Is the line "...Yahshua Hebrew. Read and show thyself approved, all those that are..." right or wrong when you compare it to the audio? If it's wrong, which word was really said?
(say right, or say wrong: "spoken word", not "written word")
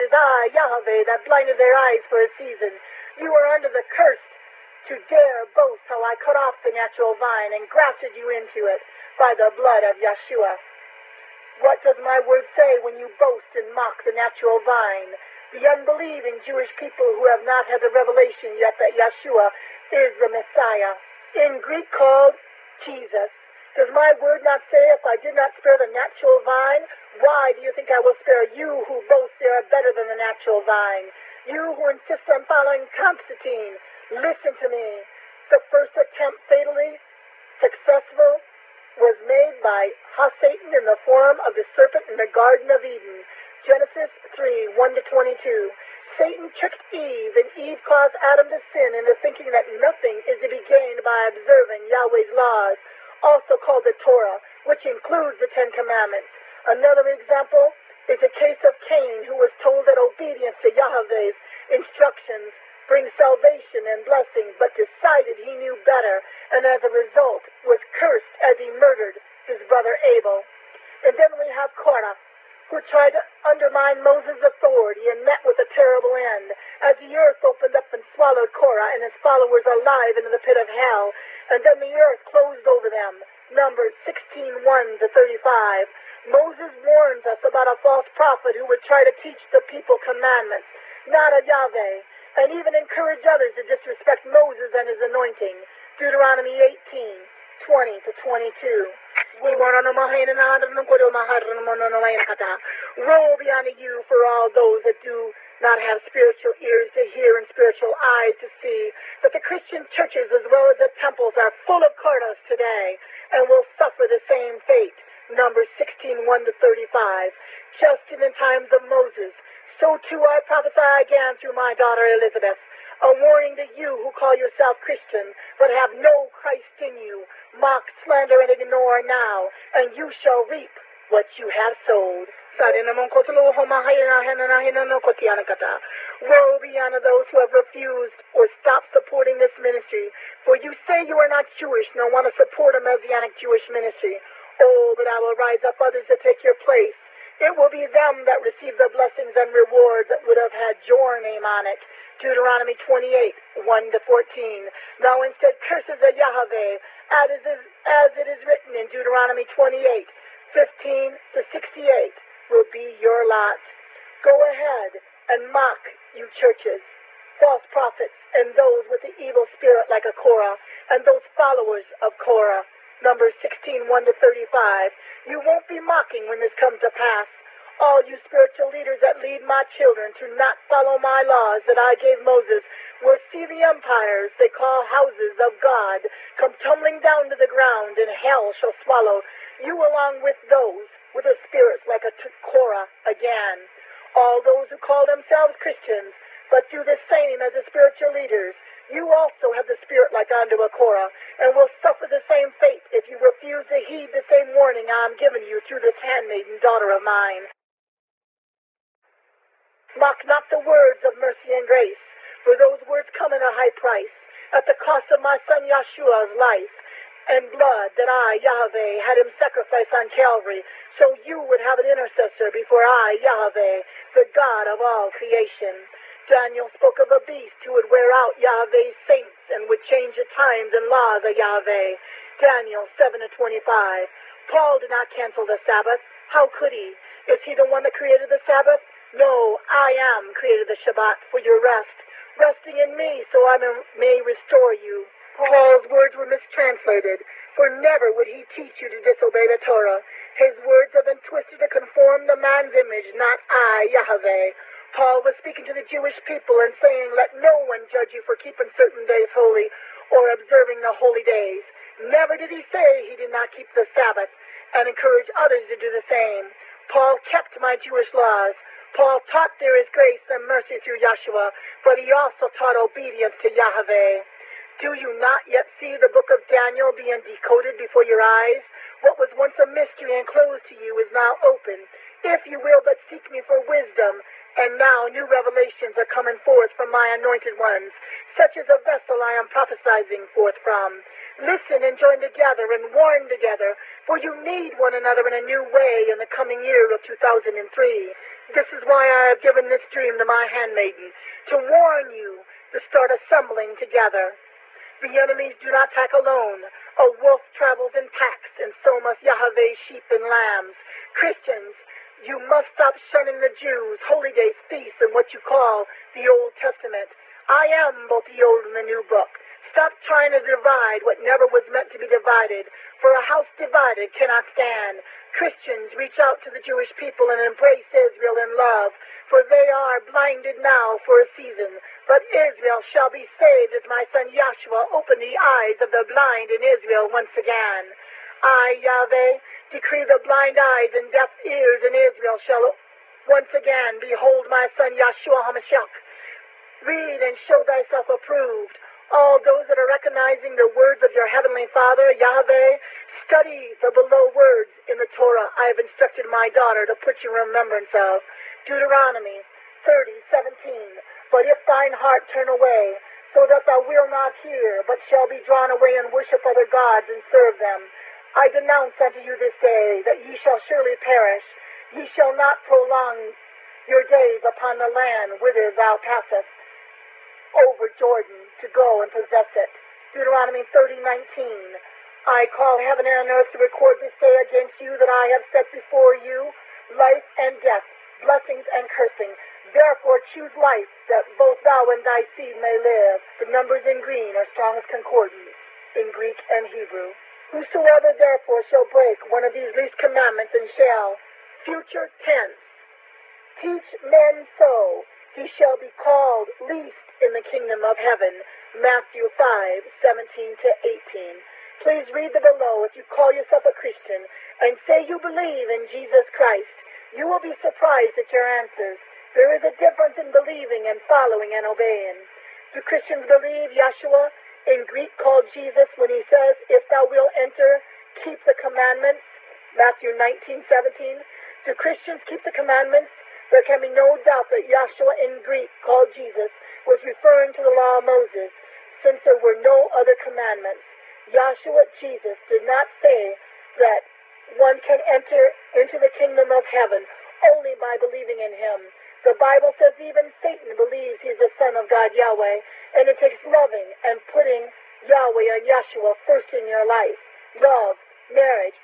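wrong: "HaMashiach", not "Hebrew".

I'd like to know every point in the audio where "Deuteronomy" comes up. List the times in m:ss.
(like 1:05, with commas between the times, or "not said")
1:35, 2:32, 2:38, 5:58, 6:20.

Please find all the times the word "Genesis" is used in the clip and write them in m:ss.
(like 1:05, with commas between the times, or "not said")
0:43.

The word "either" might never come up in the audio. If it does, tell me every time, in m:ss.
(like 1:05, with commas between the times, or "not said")
not said.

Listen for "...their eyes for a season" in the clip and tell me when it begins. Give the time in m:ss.
0:01.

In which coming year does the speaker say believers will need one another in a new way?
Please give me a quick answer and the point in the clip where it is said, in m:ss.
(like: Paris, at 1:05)
2003, at 4:57.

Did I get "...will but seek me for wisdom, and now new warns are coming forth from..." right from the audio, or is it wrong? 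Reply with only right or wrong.
wrong.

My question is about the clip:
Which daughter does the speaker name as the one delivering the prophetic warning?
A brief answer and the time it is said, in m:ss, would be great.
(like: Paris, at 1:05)
Elizabeth, at 2:02.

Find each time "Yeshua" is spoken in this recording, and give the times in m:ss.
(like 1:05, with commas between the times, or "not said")
0:09, 0:18, 3:35, 4:31, 7:03.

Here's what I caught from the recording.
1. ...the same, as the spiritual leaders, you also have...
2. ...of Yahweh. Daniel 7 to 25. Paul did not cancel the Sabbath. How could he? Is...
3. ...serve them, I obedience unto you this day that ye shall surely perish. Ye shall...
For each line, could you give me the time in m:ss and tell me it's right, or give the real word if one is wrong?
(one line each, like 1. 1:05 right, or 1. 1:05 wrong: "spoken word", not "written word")
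1. 3:16 right
2. 3:51 right
3. 6:07 wrong: "denounce", not "obedience".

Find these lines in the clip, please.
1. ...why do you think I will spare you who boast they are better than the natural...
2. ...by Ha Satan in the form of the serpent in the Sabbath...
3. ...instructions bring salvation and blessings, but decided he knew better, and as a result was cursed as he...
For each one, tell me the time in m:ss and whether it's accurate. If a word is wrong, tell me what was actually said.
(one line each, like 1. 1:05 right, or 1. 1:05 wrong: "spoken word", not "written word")
1. 0:27 right
2. 0:39 wrong: "Garden", not "Sabbath"
3. 1:01 right.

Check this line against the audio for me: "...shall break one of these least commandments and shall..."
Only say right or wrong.
right.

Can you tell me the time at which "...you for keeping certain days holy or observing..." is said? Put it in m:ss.
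4:18.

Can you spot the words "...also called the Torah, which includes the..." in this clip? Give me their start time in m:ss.
0:53.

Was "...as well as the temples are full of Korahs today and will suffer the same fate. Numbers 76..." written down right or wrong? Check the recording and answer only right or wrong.
wrong.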